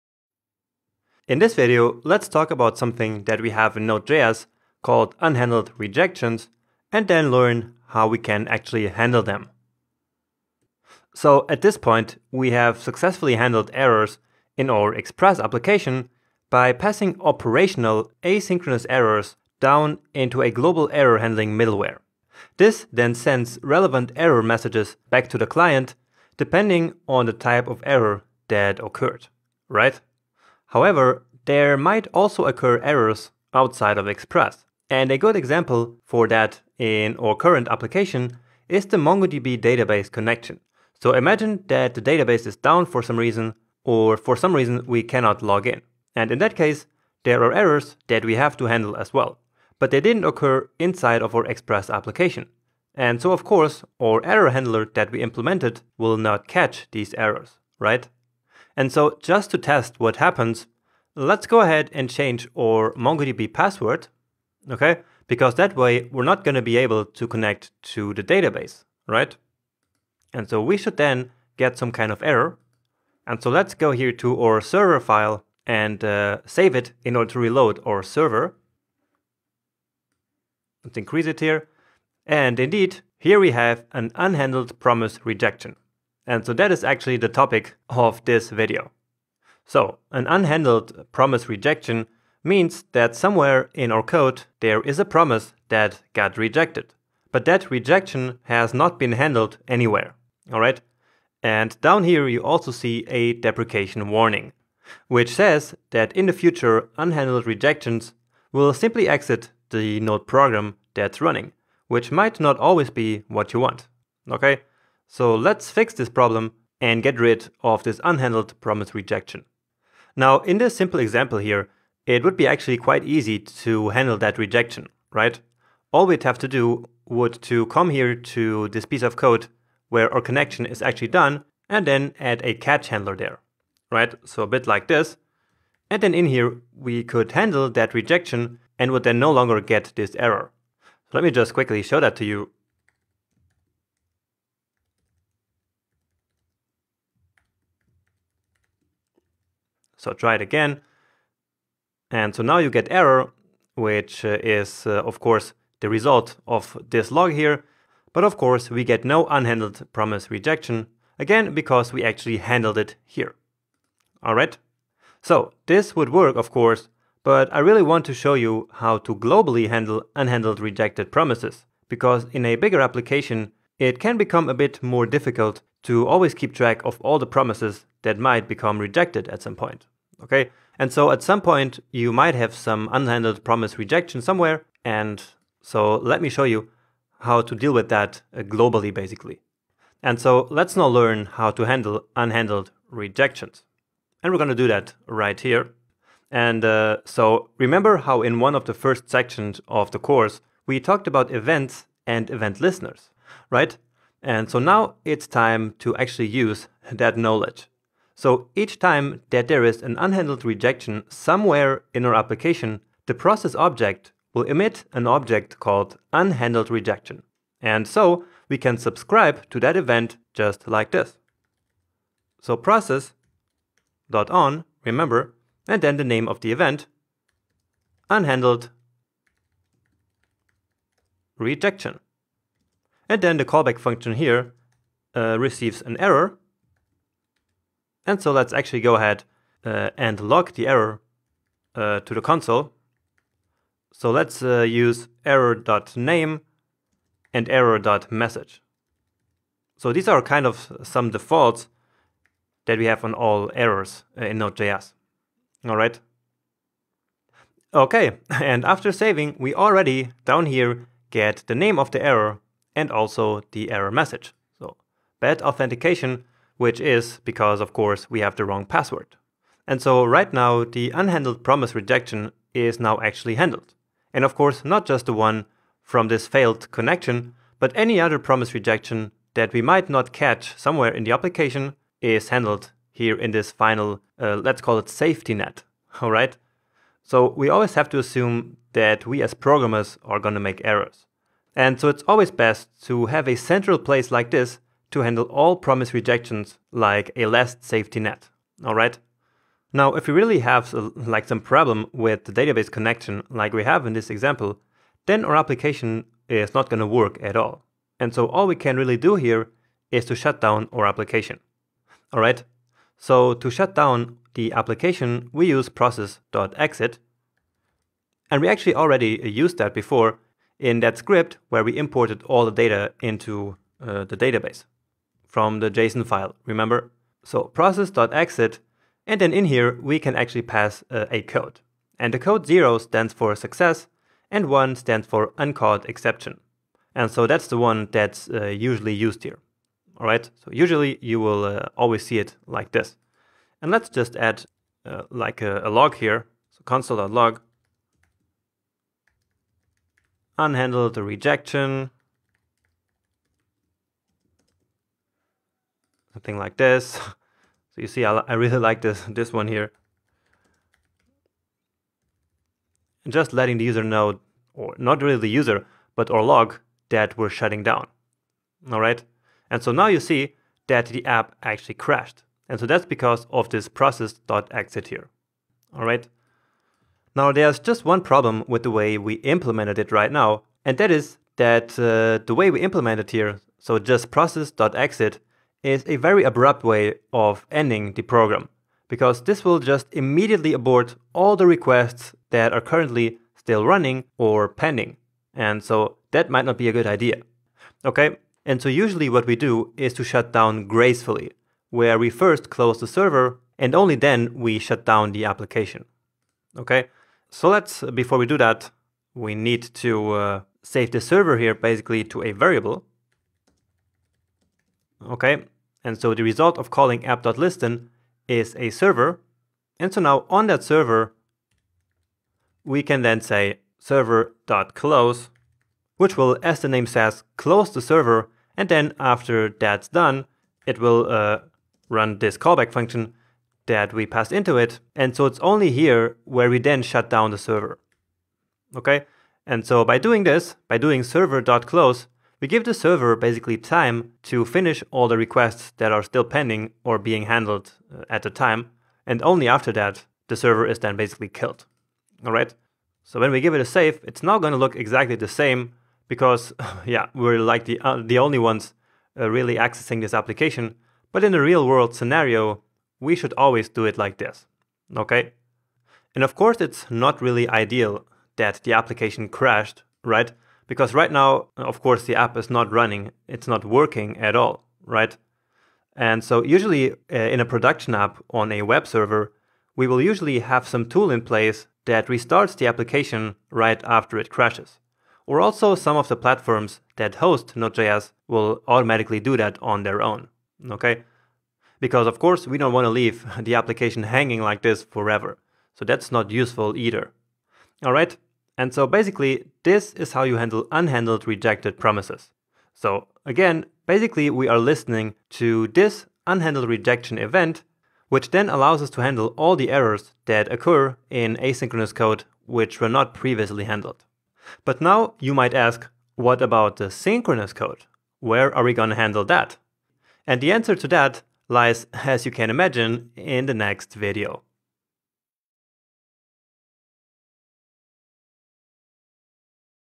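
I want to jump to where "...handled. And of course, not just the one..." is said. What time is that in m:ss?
4:33.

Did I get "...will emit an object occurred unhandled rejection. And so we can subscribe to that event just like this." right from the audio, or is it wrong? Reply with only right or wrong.
wrong.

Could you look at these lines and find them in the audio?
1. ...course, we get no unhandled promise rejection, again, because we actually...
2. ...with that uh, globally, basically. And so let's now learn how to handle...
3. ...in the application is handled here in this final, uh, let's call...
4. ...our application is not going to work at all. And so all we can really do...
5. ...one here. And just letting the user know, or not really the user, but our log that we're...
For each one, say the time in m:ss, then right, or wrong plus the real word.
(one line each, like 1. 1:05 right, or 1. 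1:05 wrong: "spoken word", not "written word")
1. 2:38 right
2. 3:07 right
3. 4:40 right
4. 5:05 right
5. 5:59 right.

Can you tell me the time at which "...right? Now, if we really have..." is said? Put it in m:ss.
4:58.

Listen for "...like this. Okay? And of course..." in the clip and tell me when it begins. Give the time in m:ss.
7:43.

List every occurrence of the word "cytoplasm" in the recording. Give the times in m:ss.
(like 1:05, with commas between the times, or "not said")
not said.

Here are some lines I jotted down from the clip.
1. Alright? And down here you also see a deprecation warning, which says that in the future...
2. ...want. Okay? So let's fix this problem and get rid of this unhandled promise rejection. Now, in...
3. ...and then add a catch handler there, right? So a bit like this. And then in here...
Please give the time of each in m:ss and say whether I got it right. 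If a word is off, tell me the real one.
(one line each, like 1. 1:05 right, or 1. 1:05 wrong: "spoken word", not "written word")
1. 1:40 right
2. 1:53 right
3. 2:11 right.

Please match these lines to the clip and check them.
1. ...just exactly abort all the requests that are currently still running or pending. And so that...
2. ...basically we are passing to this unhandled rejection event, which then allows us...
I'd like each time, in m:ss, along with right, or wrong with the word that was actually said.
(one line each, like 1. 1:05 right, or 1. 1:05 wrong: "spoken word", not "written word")
1. 6:29 wrong: "immediately", not "exactly"
2. 8:23 wrong: "listening", not "passing".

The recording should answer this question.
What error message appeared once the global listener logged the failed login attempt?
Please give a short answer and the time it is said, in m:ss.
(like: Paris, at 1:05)
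bad authentication, at 4:25.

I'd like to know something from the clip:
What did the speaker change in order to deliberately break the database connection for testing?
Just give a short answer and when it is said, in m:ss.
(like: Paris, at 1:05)
MongoDB password, at 1:02.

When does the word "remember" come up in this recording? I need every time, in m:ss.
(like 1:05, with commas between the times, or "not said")
3:17, 3:44, 5:26.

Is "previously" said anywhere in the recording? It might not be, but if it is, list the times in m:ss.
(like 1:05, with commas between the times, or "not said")
8:33.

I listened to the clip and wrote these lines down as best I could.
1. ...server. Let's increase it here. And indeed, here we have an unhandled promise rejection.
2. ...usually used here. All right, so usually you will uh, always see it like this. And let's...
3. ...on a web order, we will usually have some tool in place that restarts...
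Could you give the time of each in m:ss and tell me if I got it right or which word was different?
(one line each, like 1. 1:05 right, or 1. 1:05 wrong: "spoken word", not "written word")
1. 1:18 right
2. 5:38 right
3. 7:58 wrong: "server", not "order".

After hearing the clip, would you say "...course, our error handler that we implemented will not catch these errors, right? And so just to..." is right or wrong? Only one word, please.
right.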